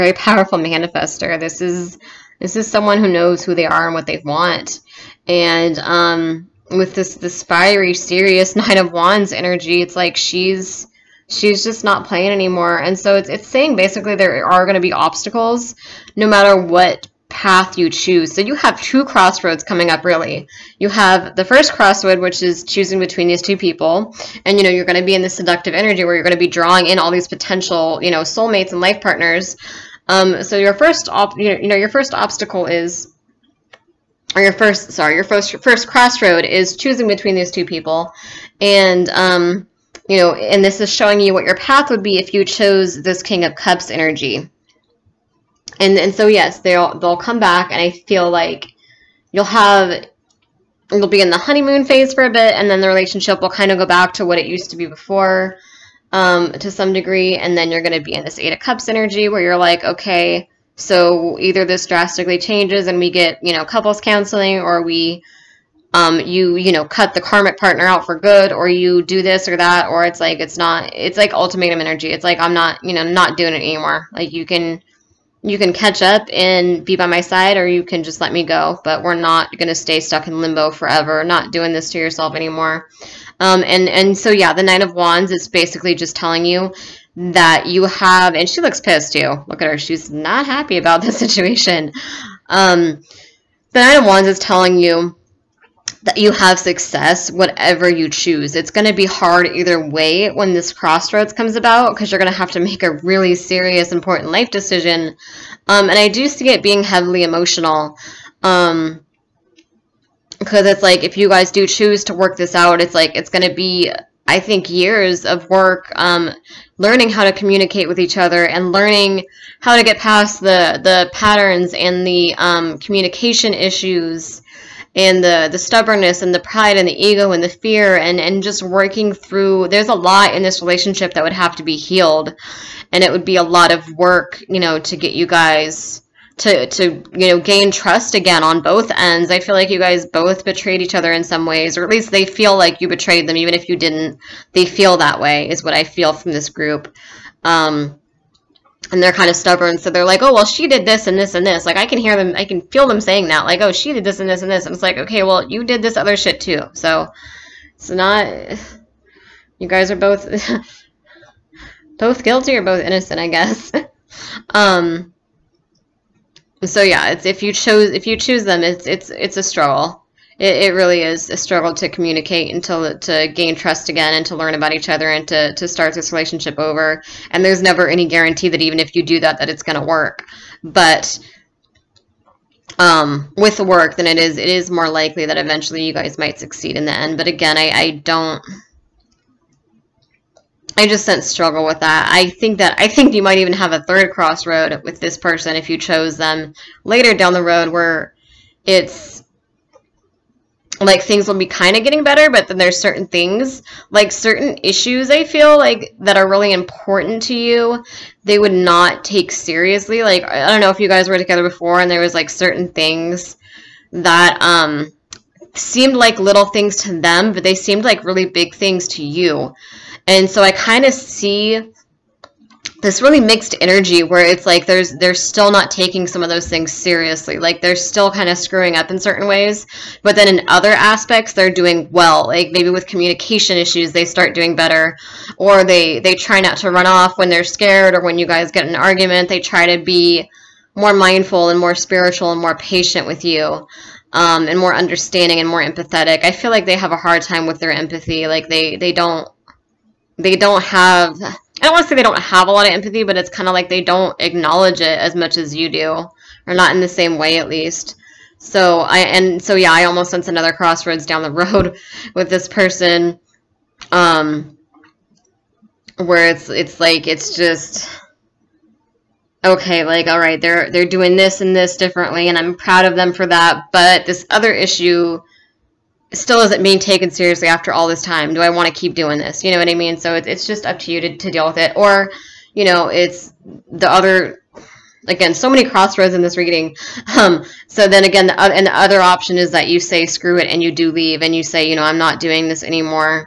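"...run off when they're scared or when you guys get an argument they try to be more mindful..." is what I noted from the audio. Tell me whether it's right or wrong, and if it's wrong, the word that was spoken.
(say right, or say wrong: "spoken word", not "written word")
right.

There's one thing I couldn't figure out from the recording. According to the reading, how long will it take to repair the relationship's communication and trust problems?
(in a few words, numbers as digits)
years of work.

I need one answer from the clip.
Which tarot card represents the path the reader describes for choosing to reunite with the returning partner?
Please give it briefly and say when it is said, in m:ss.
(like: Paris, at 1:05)
King of Cups, at 0:43.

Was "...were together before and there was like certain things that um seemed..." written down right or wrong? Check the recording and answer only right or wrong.
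right.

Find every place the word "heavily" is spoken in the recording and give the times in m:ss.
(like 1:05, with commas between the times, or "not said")
1:46.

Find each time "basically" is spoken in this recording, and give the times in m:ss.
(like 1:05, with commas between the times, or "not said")
0:13, 1:25.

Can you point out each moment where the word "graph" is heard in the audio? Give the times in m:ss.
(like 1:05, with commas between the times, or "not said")
not said.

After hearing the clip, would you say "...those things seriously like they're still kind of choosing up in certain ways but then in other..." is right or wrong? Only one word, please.
wrong.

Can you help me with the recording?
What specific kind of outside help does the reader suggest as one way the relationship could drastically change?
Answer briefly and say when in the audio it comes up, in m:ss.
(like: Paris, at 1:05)
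couples counseling, at 1:03.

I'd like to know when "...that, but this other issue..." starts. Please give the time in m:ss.
4:33.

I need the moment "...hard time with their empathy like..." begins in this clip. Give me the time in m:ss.
4:06.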